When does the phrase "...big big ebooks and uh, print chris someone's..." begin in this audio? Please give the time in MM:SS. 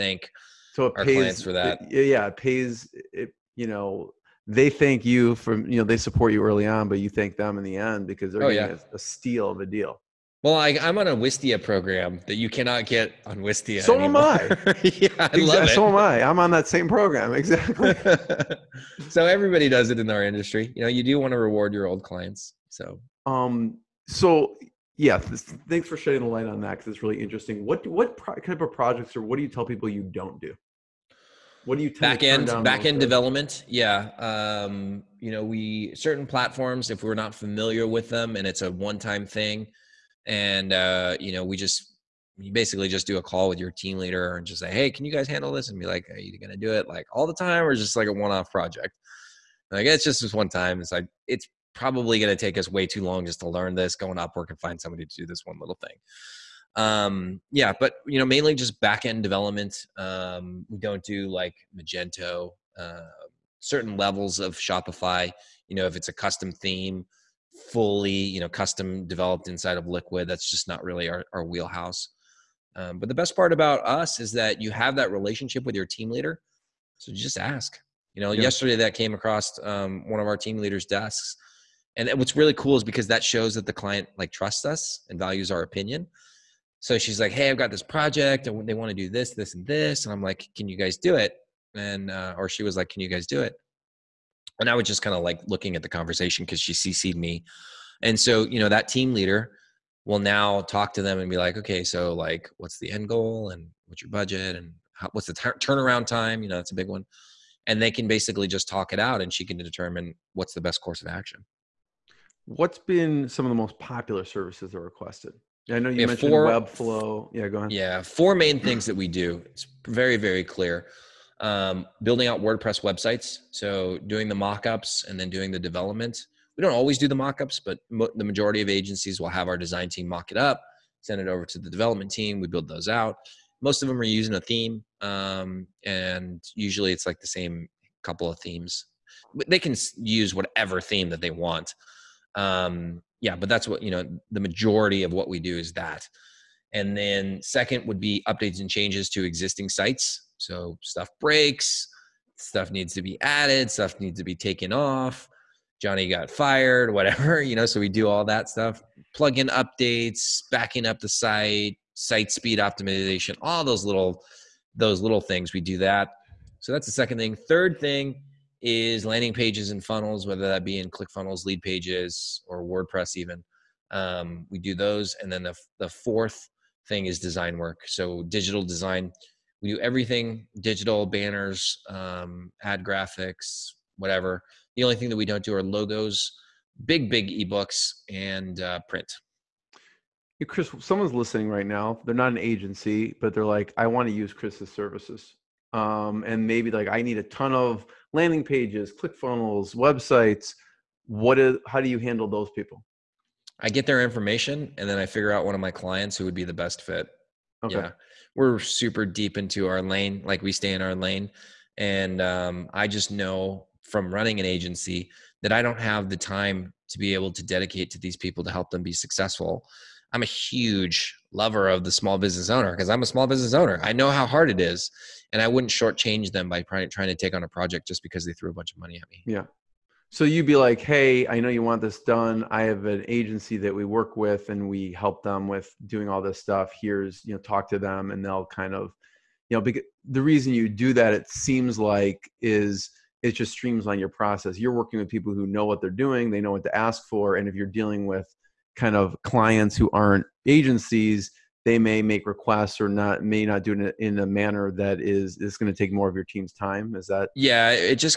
03:06.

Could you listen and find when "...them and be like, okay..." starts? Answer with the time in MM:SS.
01:41.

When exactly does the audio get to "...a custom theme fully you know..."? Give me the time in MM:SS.
01:06.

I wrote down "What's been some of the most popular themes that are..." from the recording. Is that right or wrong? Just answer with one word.
wrong.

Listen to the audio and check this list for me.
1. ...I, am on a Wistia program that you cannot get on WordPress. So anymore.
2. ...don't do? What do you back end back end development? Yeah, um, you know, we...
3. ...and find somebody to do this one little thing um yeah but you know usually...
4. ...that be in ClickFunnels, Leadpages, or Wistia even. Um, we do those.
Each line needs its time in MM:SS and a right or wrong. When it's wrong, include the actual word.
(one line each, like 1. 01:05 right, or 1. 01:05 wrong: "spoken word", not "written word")
1. 00:10 wrong: "Wistia", not "WordPress"
2. 00:30 right
3. 00:54 wrong: "mainly", not "usually"
4. 02:50 wrong: "WordPress", not "Wistia".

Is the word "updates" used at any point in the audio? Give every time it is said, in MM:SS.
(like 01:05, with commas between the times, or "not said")
02:28, 02:39.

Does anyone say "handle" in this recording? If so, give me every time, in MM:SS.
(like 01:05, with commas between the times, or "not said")
00:45, 03:21.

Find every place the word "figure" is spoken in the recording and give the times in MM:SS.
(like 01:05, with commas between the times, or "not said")
03:25.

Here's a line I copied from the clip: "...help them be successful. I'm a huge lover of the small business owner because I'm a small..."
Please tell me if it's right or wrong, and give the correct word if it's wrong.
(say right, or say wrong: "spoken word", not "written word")
right.